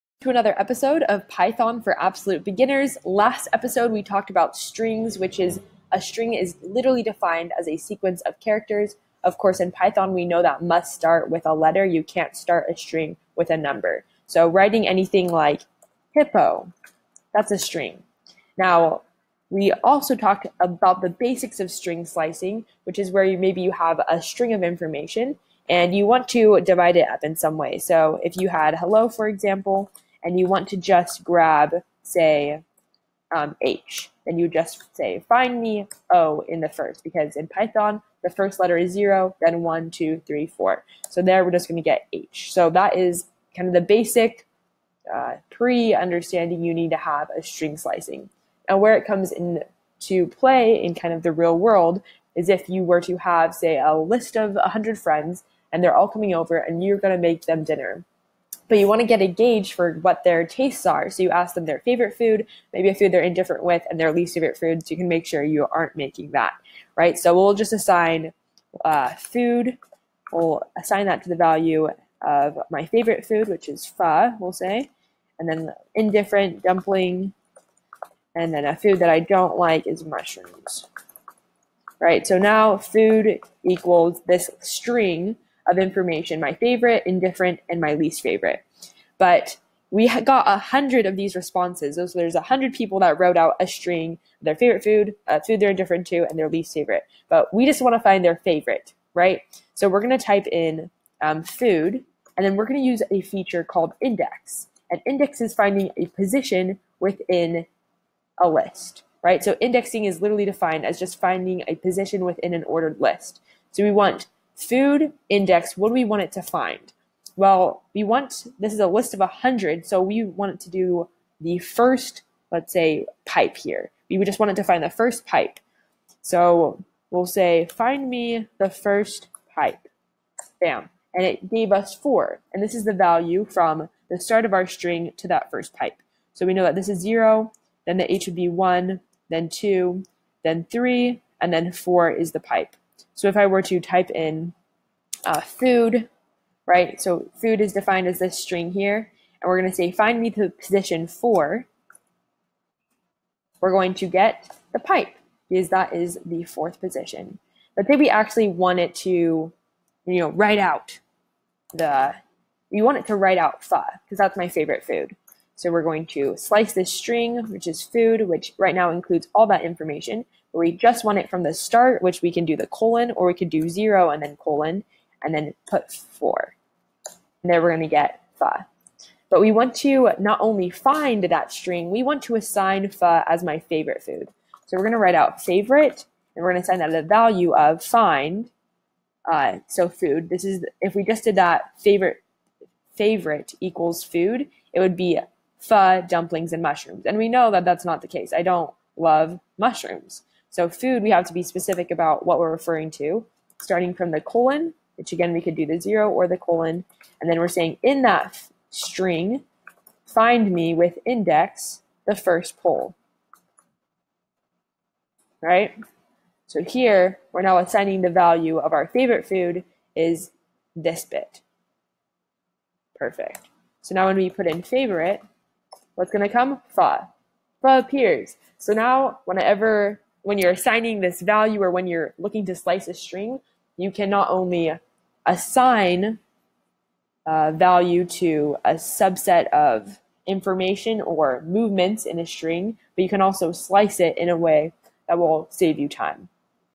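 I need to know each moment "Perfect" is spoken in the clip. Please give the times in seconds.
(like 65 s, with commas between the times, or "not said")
222 s.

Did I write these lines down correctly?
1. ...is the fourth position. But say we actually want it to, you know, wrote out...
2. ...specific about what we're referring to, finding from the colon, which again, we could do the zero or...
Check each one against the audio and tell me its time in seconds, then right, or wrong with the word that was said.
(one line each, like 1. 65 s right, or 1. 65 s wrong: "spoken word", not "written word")
1. 155 s wrong: "write", not "wrote"
2. 201 s wrong: "starting", not "finding".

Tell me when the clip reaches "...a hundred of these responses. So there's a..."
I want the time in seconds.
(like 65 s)
90 s.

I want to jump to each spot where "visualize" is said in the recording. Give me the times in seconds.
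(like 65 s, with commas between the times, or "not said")
not said.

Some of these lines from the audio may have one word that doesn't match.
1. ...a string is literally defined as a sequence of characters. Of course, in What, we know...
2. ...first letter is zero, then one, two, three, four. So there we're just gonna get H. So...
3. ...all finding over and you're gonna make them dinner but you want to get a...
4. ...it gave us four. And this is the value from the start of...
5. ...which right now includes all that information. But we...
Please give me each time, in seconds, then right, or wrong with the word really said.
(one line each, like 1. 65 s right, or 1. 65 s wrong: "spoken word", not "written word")
1. 5 s wrong: "Python", not "What"
2. 38 s right
3. 55 s wrong: "coming", not "finding"
4. 131 s right
5. 168 s right.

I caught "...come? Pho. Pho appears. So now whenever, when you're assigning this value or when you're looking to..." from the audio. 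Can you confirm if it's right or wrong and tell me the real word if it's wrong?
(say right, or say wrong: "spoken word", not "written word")
right.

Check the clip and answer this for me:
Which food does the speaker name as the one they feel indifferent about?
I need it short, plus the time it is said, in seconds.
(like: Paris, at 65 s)
Dumpling, at 76 s.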